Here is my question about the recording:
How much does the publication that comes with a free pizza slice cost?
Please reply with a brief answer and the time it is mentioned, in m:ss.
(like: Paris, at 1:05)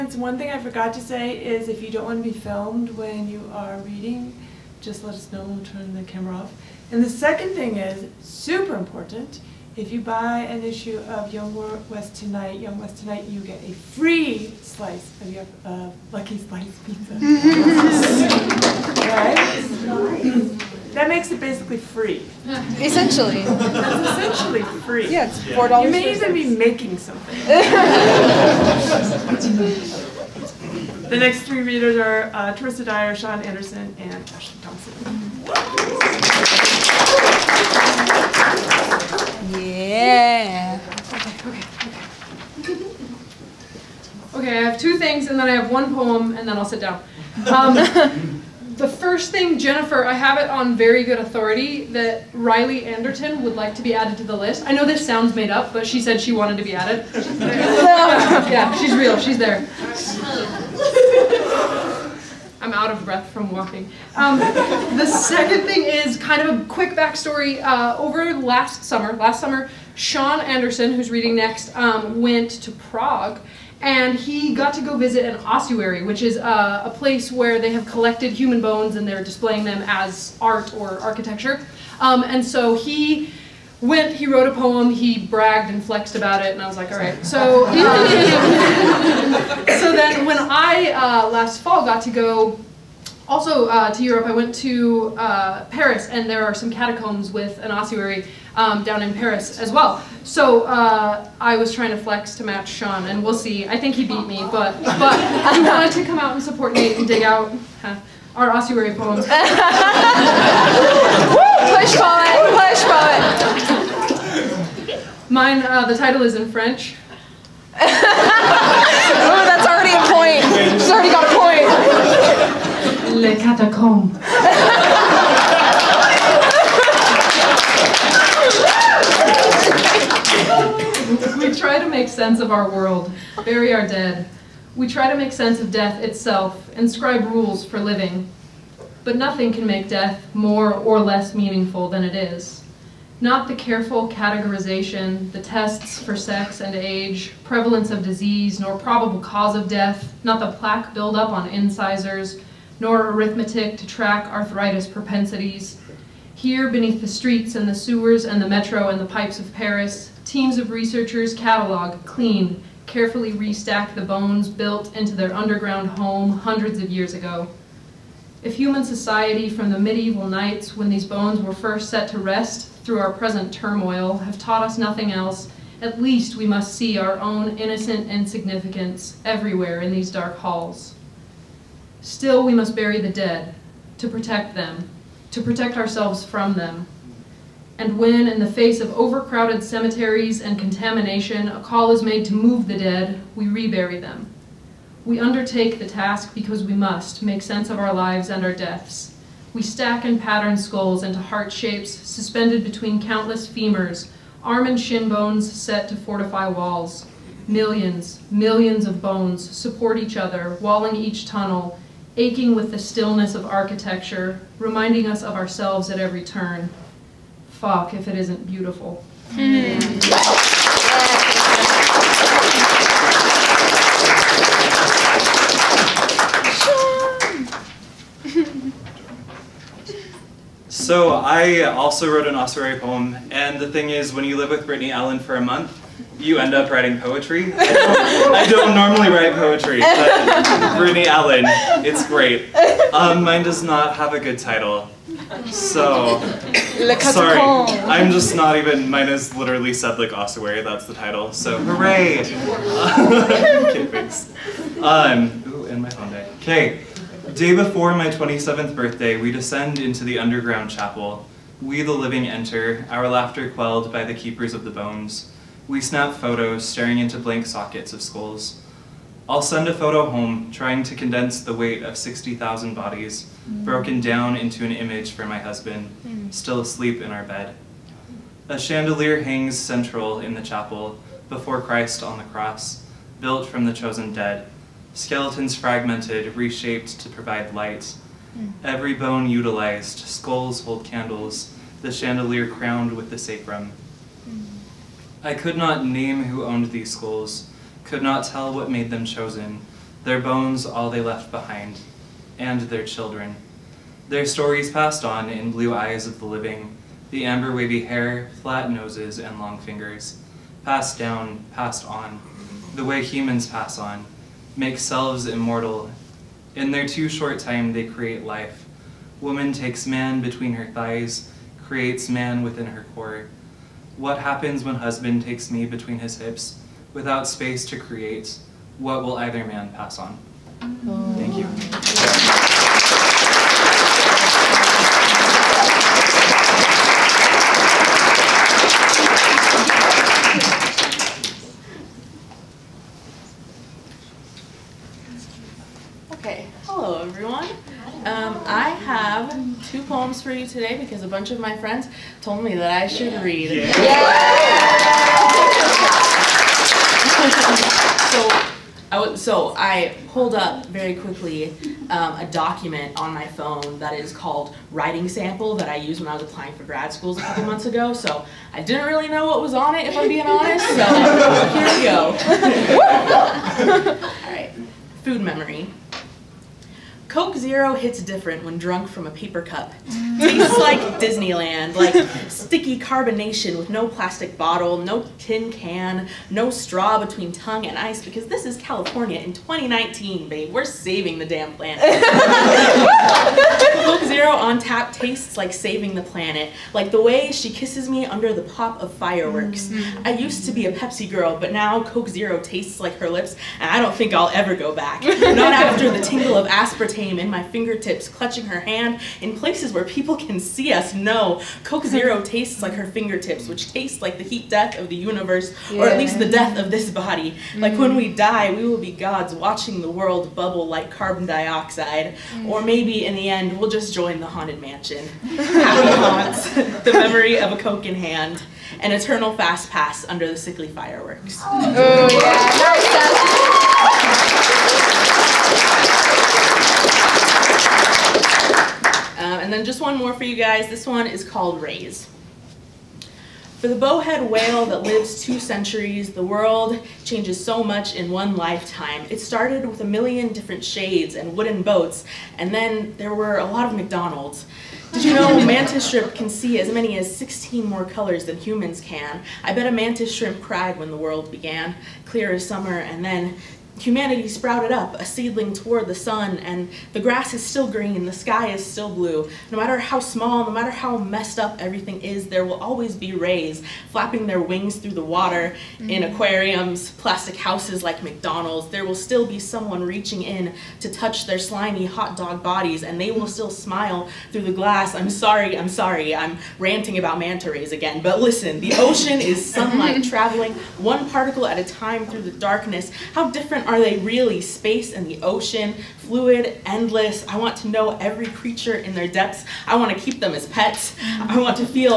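$4, at 0:25.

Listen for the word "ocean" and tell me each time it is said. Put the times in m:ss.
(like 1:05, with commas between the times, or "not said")
8:08, 8:15.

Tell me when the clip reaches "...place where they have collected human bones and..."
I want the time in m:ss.
1:16.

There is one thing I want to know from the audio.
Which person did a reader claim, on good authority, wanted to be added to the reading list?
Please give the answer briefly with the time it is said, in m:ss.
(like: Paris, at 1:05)
Riley Anderton, at 0:52.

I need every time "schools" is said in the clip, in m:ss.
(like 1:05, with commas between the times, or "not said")
6:06.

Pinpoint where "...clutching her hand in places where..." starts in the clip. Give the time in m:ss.
6:48.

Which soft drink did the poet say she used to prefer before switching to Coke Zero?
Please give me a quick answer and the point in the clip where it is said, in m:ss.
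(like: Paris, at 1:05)
Pepsi, at 6:40.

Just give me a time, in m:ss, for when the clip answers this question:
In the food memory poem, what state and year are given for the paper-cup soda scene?
6:28.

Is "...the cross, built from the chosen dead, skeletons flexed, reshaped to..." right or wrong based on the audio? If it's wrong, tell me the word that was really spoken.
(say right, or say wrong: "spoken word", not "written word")
wrong: "fragmented", not "flexed".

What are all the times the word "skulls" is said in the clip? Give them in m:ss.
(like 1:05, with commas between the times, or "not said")
3:20, 4:28, 4:49, 4:56.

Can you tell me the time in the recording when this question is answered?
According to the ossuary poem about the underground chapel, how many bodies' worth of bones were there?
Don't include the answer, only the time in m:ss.
4:31.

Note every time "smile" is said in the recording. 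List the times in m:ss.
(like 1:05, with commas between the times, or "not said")
8:03.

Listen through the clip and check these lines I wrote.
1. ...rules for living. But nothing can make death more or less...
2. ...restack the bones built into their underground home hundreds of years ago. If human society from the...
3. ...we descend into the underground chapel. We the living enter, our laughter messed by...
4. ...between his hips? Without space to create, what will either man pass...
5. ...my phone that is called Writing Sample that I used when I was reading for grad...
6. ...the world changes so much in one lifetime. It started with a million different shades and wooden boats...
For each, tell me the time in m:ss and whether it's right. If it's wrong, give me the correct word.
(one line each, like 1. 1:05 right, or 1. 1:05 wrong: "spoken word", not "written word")
1. 2:17 right
2. 2:43 right
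3. 4:19 wrong: "quelled", not "messed"
4. 5:25 right
5. 6:03 wrong: "applying", not "reading"
6. 7:26 right.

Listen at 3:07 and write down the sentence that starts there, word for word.
And when, in the face of overcrowded cemeteries and contamination, a call is made to move the dead, we rebury them.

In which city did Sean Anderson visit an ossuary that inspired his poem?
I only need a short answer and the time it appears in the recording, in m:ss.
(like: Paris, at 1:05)
Prague, at 1:12.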